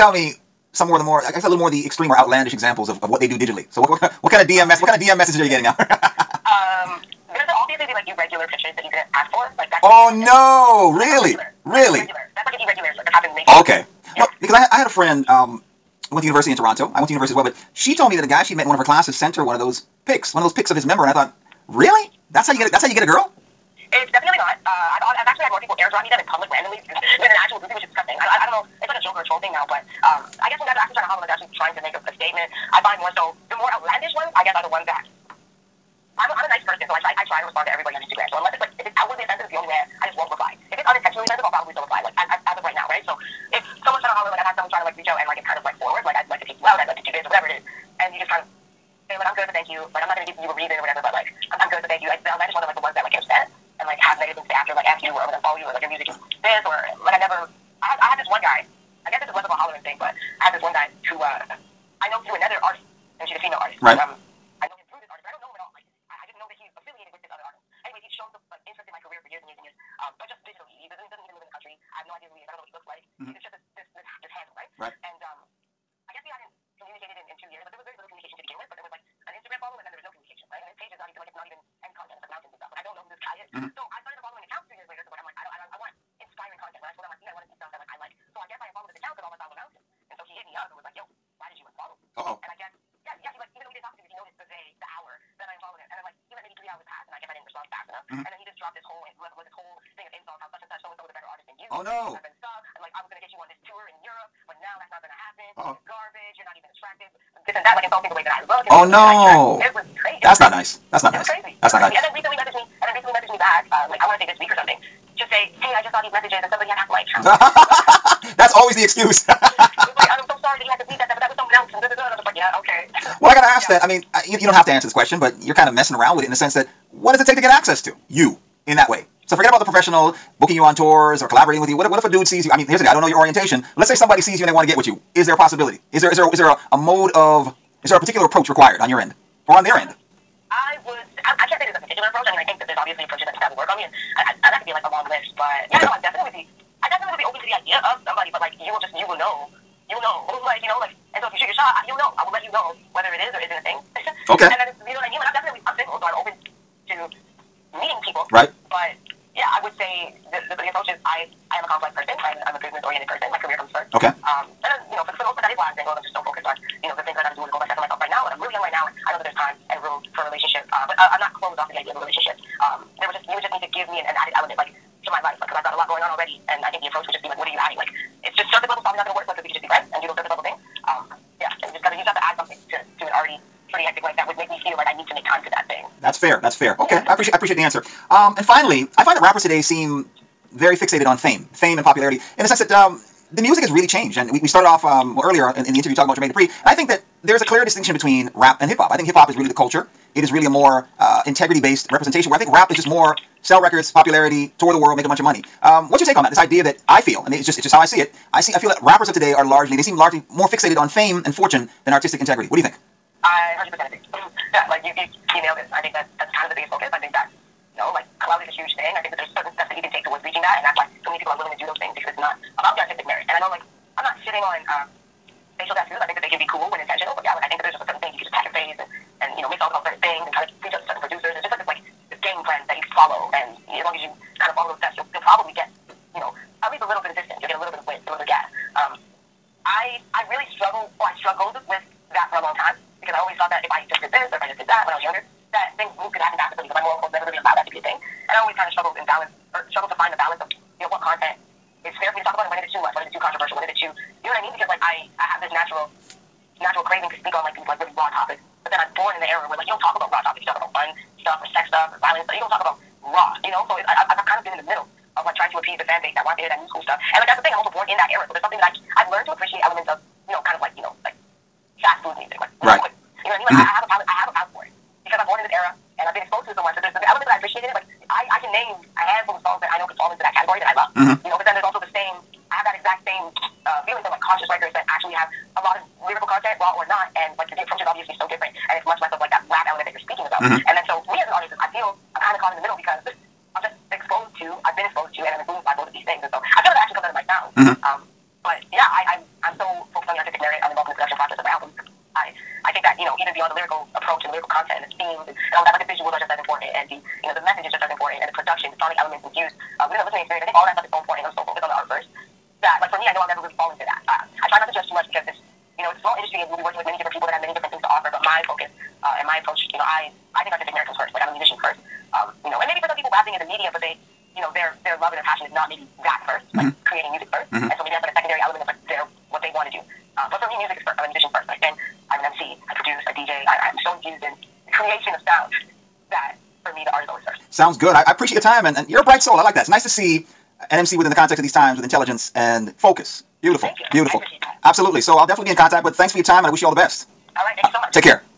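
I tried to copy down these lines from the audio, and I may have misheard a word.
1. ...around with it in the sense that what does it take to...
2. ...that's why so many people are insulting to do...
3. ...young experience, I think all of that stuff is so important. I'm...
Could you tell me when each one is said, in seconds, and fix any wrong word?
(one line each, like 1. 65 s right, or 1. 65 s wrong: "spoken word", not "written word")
1. 125 s right
2. 220 s wrong: "willing", not "insulting"
3. 310 s wrong: "listening", not "young".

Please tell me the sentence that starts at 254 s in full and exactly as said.
Because like I, I have this natural, natural craving to speak on like these like really raw topics.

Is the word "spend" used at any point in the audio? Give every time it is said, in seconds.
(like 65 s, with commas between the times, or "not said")
331 s.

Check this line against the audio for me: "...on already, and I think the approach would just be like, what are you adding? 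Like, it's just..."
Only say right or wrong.
right.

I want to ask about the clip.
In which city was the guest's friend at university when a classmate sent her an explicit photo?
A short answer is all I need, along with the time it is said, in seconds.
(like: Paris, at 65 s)
Toronto, at 16 s.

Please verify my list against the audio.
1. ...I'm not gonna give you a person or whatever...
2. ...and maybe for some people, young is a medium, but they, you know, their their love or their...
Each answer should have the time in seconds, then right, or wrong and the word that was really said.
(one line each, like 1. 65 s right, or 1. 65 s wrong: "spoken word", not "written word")
1. 50 s wrong: "reason", not "person"
2. 322 s wrong: "rapping", not "young".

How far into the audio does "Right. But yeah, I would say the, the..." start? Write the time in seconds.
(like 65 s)
158 s.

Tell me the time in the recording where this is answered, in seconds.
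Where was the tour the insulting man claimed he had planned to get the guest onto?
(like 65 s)
104 s.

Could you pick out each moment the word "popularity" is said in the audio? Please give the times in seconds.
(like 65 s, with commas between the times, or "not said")
191 s, 203 s.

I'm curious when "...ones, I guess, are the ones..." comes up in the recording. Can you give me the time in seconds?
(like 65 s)
34 s.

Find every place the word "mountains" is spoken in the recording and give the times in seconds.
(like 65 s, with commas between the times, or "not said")
82 s, 89 s.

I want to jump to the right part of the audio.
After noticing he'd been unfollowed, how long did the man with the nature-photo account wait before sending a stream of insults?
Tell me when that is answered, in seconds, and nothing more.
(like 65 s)
96 s.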